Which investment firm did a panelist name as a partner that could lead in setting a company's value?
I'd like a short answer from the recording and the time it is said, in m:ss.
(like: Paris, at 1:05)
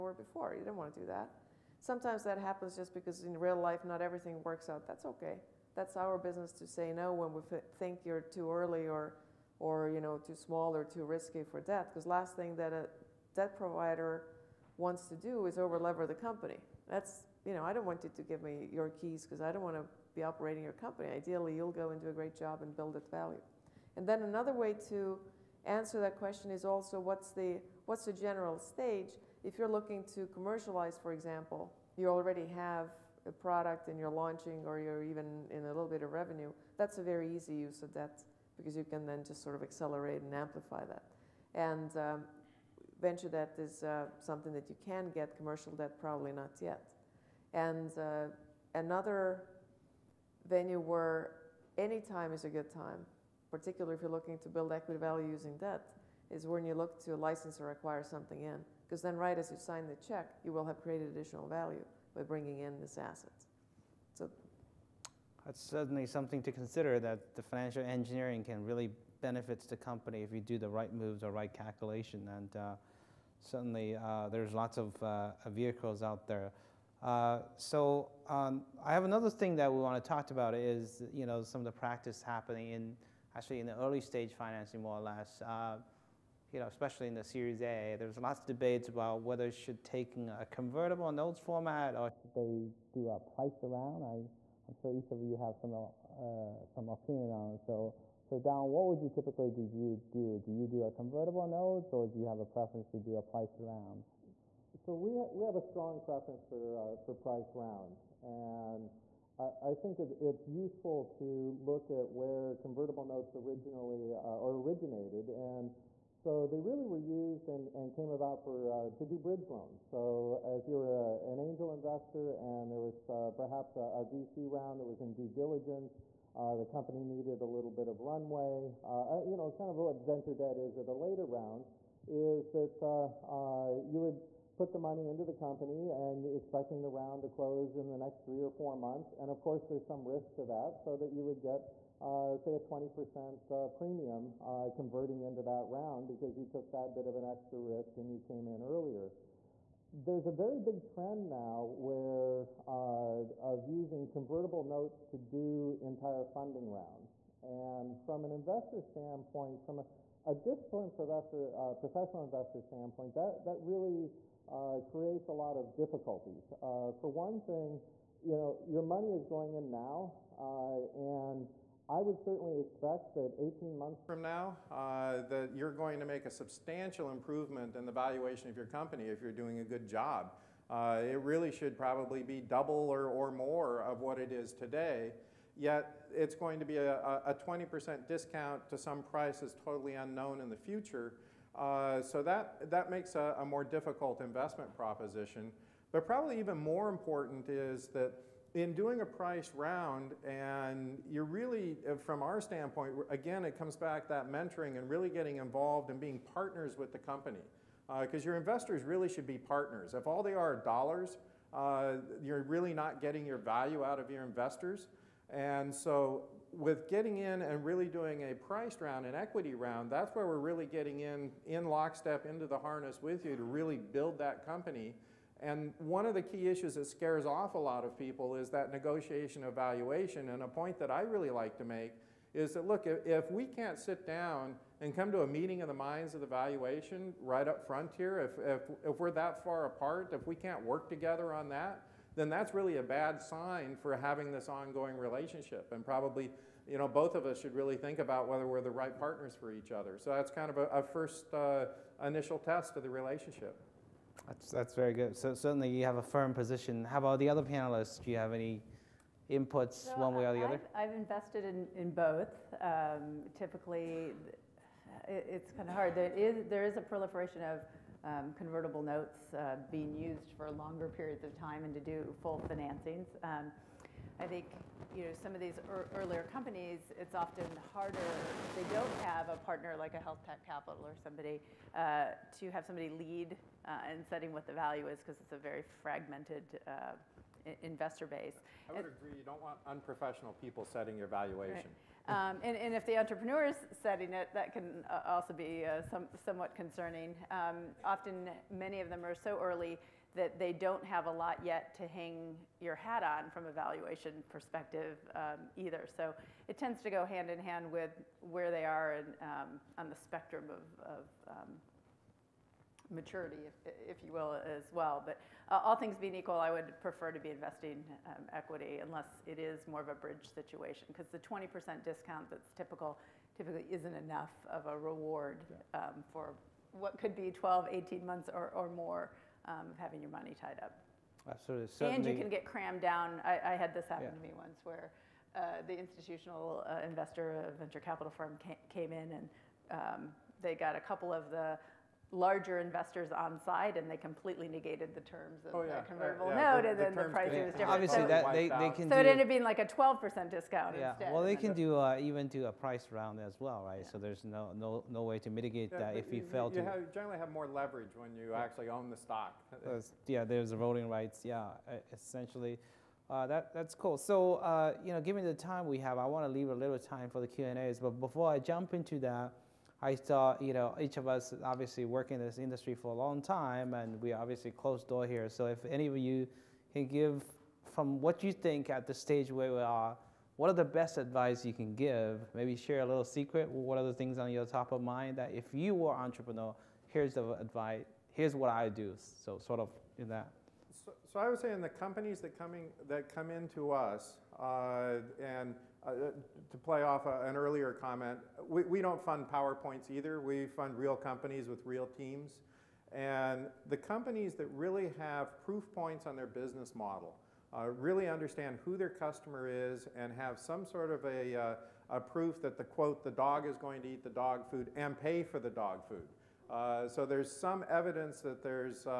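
health tech capital, at 4:39.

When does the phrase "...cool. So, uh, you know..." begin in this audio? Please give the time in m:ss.
6:03.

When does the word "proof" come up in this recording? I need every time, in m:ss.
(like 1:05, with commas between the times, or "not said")
6:45, 6:51.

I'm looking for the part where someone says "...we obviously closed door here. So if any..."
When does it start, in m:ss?
6:14.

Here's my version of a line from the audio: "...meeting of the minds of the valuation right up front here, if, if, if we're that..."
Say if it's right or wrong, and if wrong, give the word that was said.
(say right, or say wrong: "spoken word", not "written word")
right.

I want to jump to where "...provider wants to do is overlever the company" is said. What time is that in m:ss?
0:13.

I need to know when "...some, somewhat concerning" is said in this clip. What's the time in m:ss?
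4:55.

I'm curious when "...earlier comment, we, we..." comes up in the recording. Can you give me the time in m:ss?
6:37.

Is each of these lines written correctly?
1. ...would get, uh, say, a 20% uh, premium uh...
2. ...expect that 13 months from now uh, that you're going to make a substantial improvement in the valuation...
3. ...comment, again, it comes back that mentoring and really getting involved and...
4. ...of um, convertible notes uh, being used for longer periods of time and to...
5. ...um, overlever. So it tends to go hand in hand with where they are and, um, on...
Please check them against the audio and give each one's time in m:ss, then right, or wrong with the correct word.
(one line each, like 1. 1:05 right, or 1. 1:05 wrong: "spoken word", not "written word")
1. 2:21 right
2. 2:52 wrong: "18", not "13"
3. 3:22 wrong: "standpoint", not "comment"
4. 4:27 right
5. 5:05 wrong: "either", not "overlever".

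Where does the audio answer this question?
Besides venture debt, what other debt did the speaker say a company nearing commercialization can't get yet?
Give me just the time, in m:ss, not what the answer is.
0:45.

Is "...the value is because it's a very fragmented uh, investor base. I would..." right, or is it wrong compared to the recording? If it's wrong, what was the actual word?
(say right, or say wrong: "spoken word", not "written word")
right.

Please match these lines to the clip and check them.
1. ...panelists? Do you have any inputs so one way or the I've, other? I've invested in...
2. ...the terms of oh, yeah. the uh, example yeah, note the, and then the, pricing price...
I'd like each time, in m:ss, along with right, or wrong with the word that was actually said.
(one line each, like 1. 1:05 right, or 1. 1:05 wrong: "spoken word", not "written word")
1. 4:17 right
2. 5:44 wrong: "convertible", not "example".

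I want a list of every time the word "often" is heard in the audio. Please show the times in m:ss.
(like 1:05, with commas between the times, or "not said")
4:37, 4:57.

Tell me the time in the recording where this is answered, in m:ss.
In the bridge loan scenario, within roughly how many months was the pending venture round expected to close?
2:18.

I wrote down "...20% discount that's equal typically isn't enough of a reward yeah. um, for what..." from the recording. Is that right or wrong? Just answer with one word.
wrong.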